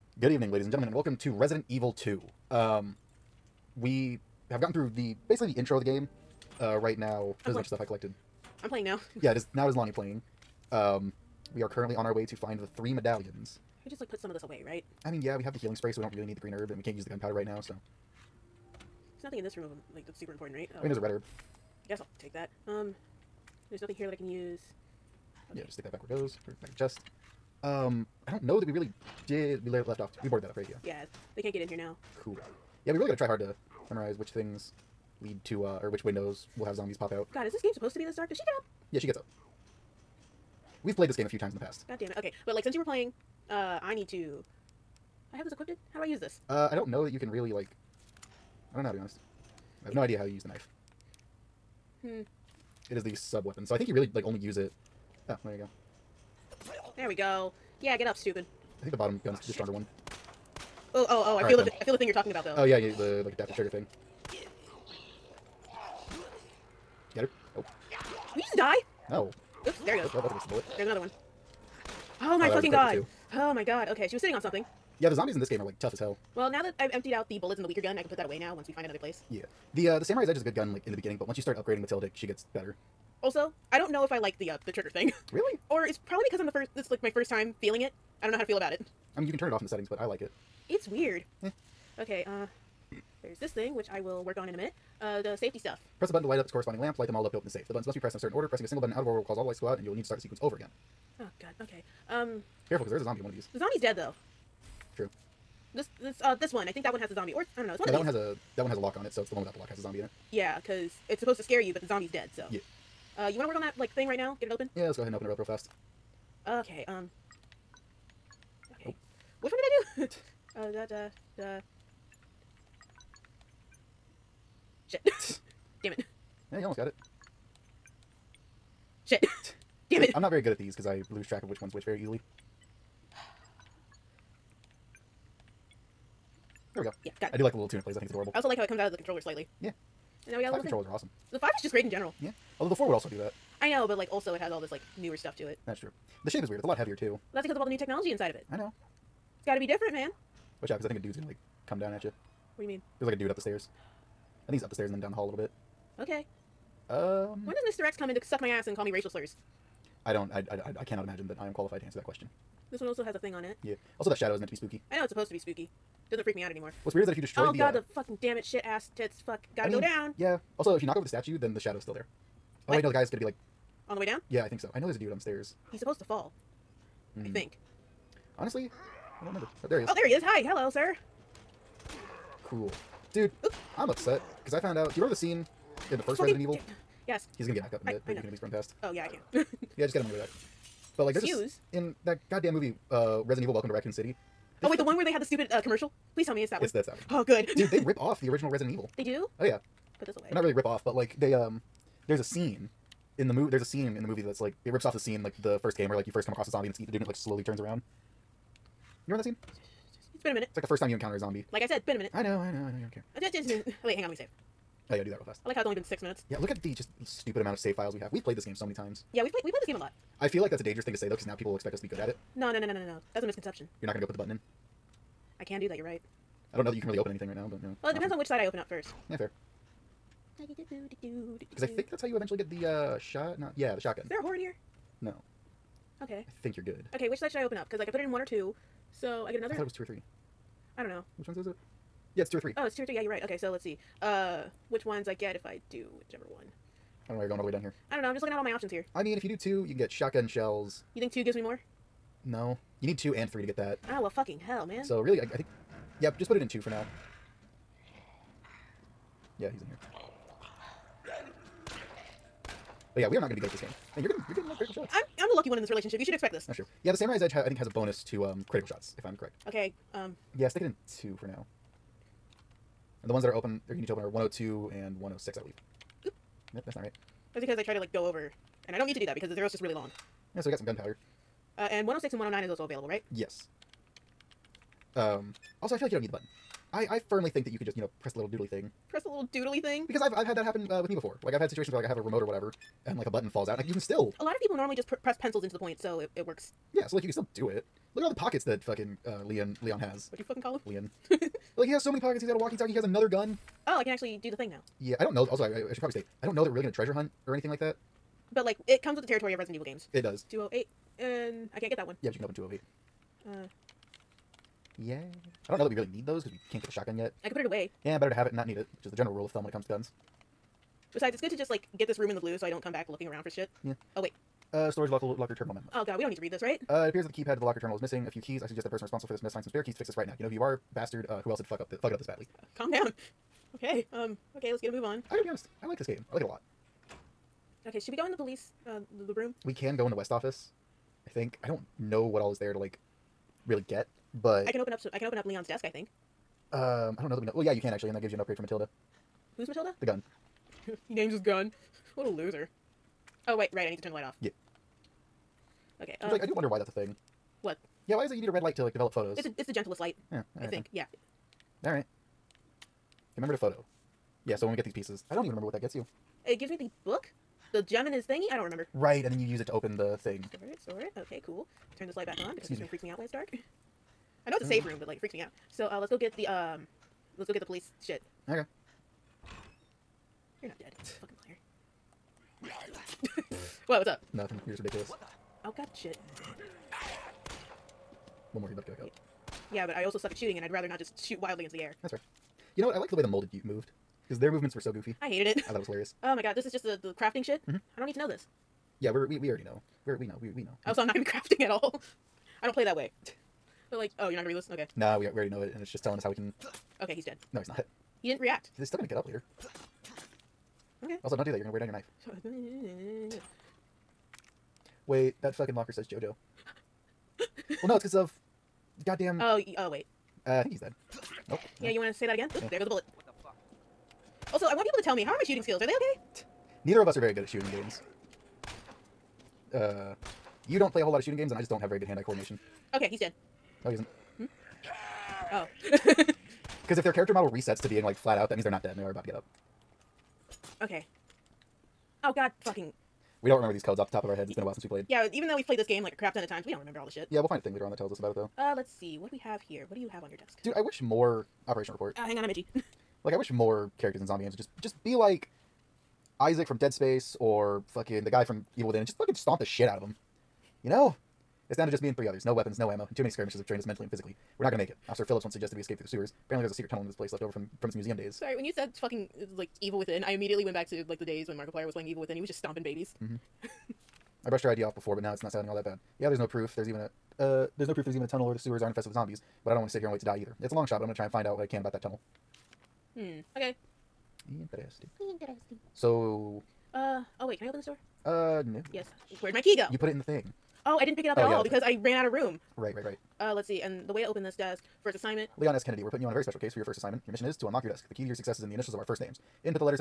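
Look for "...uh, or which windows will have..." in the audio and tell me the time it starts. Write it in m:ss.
0:35.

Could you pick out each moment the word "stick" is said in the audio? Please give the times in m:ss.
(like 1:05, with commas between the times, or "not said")
0:25, 4:30.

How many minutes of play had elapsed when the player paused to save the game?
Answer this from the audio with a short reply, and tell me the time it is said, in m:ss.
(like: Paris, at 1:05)
6, at 3:35.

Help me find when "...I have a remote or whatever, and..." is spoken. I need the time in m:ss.
4:51.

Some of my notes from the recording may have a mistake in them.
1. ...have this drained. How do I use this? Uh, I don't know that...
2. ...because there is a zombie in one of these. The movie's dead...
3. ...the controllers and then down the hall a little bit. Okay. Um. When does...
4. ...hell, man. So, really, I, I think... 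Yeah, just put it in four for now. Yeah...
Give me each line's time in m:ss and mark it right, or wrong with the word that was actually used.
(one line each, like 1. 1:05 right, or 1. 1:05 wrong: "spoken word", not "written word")
1. 0:45 wrong: "equipped", not "drained"
2. 1:42 wrong: "zombie", not "movie"
3. 2:34 wrong: "stairs", not "controllers"
4. 4:14 wrong: "two", not "four".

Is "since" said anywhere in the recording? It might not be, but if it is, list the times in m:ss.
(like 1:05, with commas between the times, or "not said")
0:42, 7:24.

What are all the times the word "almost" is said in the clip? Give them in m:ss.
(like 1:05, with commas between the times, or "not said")
2:06.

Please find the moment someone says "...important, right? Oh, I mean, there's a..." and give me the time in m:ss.
0:20.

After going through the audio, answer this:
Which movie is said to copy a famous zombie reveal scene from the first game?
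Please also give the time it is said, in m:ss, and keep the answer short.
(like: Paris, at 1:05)
Resident Evil: Welcome to Raccoon City, at 3:13.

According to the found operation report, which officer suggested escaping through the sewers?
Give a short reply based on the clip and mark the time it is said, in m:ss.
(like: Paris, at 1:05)
Officer Phillips, at 7:44.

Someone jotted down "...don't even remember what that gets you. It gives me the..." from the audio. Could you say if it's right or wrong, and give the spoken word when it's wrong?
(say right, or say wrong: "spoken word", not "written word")
right.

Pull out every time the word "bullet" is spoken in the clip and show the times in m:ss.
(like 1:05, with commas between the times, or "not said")
1:10, 1:17, 7:02.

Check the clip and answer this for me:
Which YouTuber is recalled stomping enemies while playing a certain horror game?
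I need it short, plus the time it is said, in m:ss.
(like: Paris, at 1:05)
Markiplier, at 7:51.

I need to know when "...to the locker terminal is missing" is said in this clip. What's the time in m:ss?
5:27.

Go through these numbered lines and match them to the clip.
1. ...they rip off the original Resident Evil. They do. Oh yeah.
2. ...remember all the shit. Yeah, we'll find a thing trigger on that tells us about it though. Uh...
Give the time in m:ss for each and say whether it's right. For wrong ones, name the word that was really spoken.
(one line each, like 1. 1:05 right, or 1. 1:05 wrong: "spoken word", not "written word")
1. 3:17 right
2. 7:26 wrong: "later", not "trigger".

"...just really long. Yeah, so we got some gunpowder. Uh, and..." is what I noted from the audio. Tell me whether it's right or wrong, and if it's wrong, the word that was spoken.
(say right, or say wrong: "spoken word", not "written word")
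right.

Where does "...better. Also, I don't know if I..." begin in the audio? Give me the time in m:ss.
1:22.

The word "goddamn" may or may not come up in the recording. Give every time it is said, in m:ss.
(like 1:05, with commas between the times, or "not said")
3:12, 6:58.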